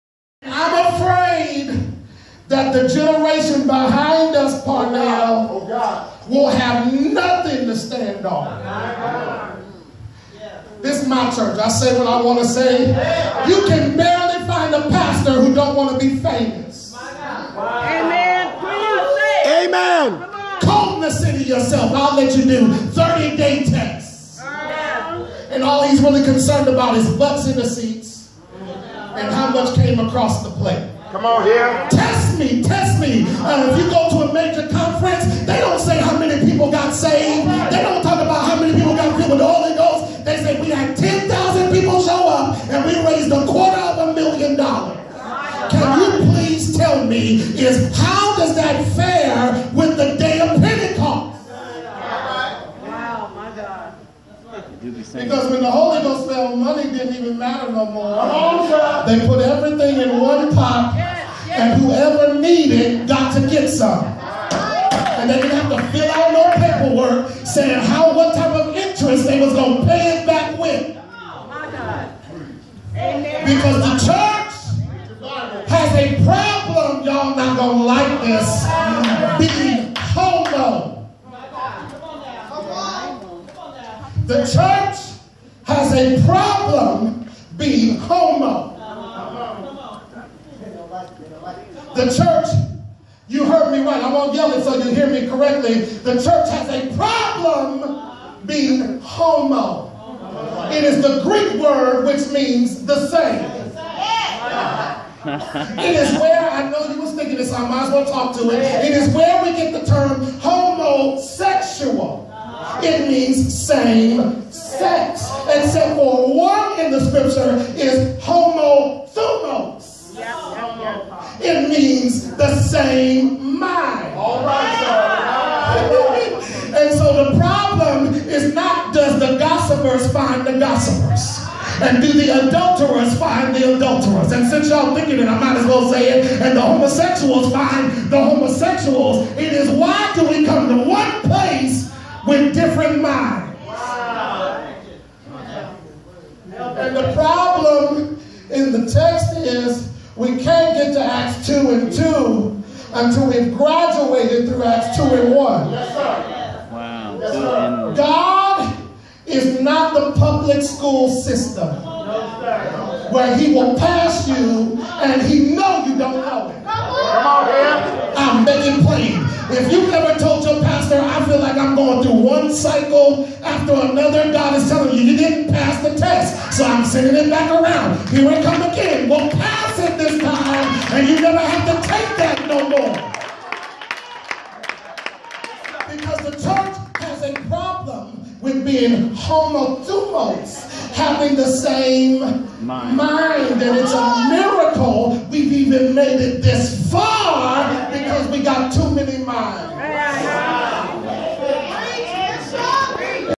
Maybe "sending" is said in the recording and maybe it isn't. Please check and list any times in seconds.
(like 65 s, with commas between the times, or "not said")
176 s.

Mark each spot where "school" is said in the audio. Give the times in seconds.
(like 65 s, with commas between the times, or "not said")
160 s.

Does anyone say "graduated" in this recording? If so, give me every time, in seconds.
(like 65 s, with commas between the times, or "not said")
153 s.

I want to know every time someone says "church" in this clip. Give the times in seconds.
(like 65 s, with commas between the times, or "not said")
11 s, 74 s, 84 s, 92 s, 96 s, 186 s.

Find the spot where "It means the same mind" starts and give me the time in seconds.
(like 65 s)
121 s.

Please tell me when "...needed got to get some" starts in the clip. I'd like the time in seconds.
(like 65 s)
62 s.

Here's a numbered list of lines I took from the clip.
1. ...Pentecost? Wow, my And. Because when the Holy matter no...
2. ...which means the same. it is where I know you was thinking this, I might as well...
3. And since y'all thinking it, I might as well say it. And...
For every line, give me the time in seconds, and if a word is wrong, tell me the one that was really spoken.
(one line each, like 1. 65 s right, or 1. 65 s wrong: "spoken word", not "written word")
1. 50 s wrong: "God", not "And"
2. 102 s right
3. 134 s right.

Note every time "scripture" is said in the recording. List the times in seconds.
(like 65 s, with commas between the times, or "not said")
117 s.